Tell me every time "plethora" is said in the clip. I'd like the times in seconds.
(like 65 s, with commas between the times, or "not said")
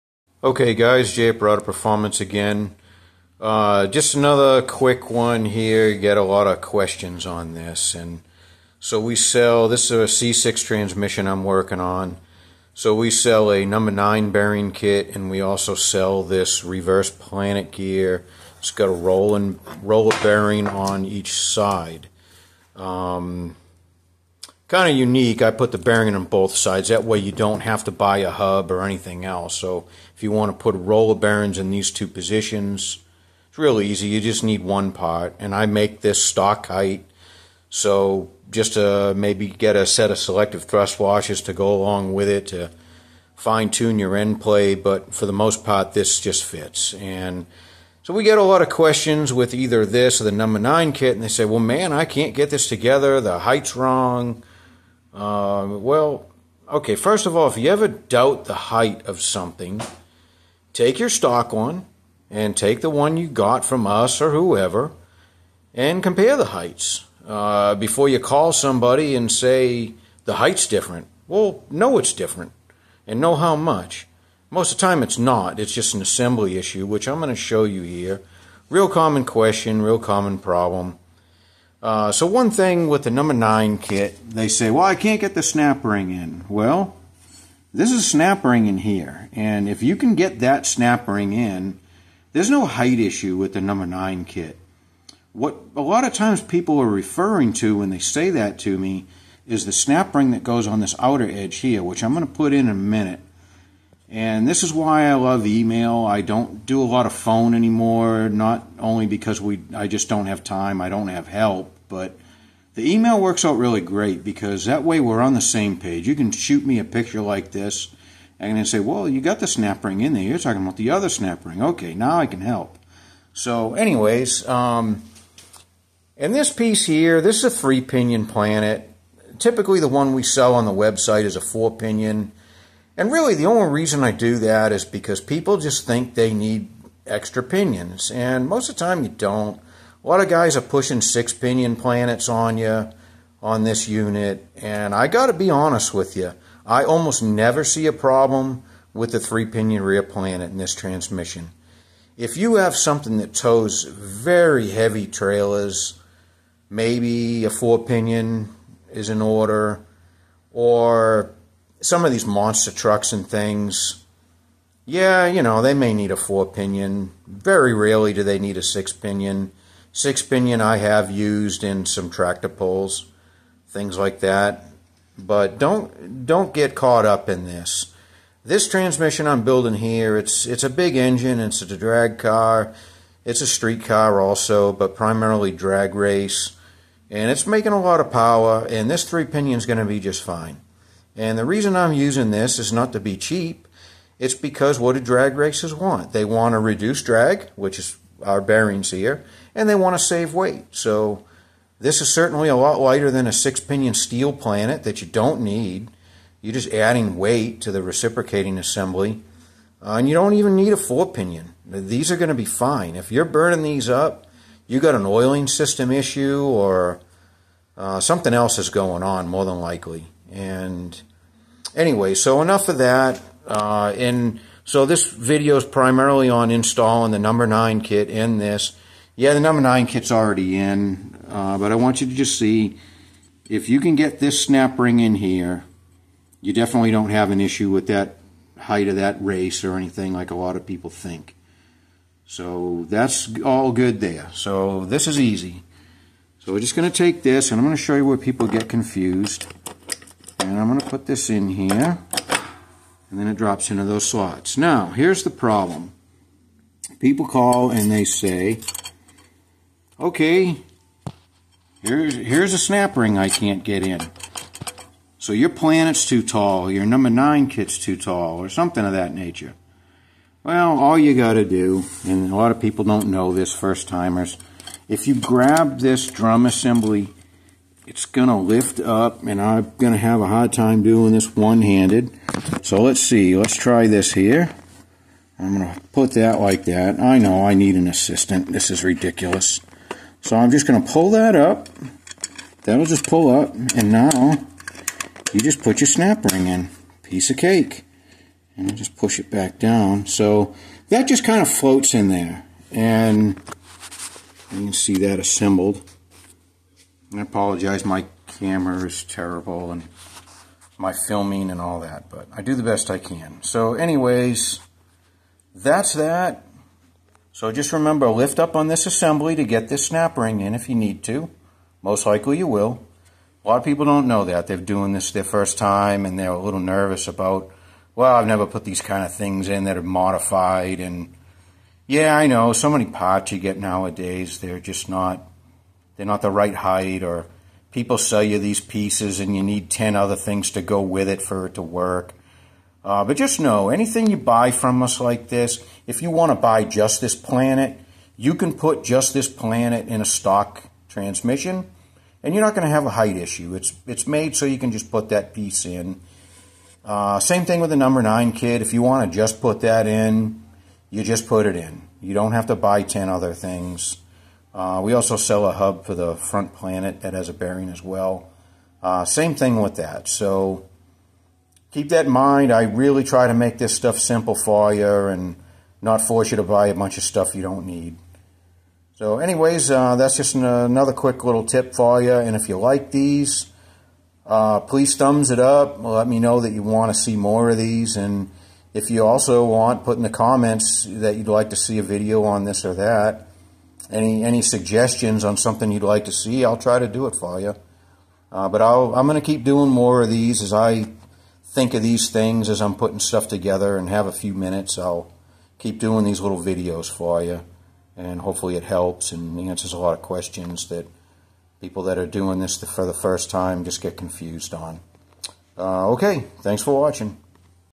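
not said.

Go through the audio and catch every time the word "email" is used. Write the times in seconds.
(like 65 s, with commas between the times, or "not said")
105 s, 112 s.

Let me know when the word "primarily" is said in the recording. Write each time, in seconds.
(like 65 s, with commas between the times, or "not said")
184 s, 225 s.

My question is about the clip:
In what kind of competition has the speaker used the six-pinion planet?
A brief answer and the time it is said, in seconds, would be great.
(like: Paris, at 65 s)
Tractor pulls, at 172 s.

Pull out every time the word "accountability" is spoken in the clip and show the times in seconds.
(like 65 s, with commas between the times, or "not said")
not said.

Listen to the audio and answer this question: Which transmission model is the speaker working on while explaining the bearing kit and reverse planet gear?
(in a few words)
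C6.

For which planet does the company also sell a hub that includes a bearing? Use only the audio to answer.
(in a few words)
The front planet.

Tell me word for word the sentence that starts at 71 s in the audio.
Well, know it's different and know how much.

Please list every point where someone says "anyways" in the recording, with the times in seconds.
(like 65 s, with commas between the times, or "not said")
123 s, 221 s, 313 s, 379 s.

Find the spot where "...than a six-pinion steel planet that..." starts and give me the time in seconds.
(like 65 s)
203 s.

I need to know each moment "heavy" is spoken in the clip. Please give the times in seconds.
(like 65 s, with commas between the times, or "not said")
154 s.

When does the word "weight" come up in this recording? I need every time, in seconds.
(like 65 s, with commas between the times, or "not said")
200 s, 207 s.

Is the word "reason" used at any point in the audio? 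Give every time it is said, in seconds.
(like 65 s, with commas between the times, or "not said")
133 s, 191 s.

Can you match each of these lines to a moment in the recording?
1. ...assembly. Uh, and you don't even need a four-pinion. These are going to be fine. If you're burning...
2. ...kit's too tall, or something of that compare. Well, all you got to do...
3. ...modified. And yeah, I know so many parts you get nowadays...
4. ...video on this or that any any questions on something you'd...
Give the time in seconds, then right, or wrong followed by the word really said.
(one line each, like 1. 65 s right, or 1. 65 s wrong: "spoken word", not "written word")
1. 208 s right
2. 267 s wrong: "nature", not "compare"
3. 329 s right
4. 391 s wrong: "suggestions", not "questions".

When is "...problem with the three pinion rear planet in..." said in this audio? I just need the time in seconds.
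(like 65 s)
147 s.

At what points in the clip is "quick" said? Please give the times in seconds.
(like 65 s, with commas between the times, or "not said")
4 s, 380 s.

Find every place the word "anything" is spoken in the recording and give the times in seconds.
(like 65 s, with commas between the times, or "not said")
28 s, 239 s, 343 s.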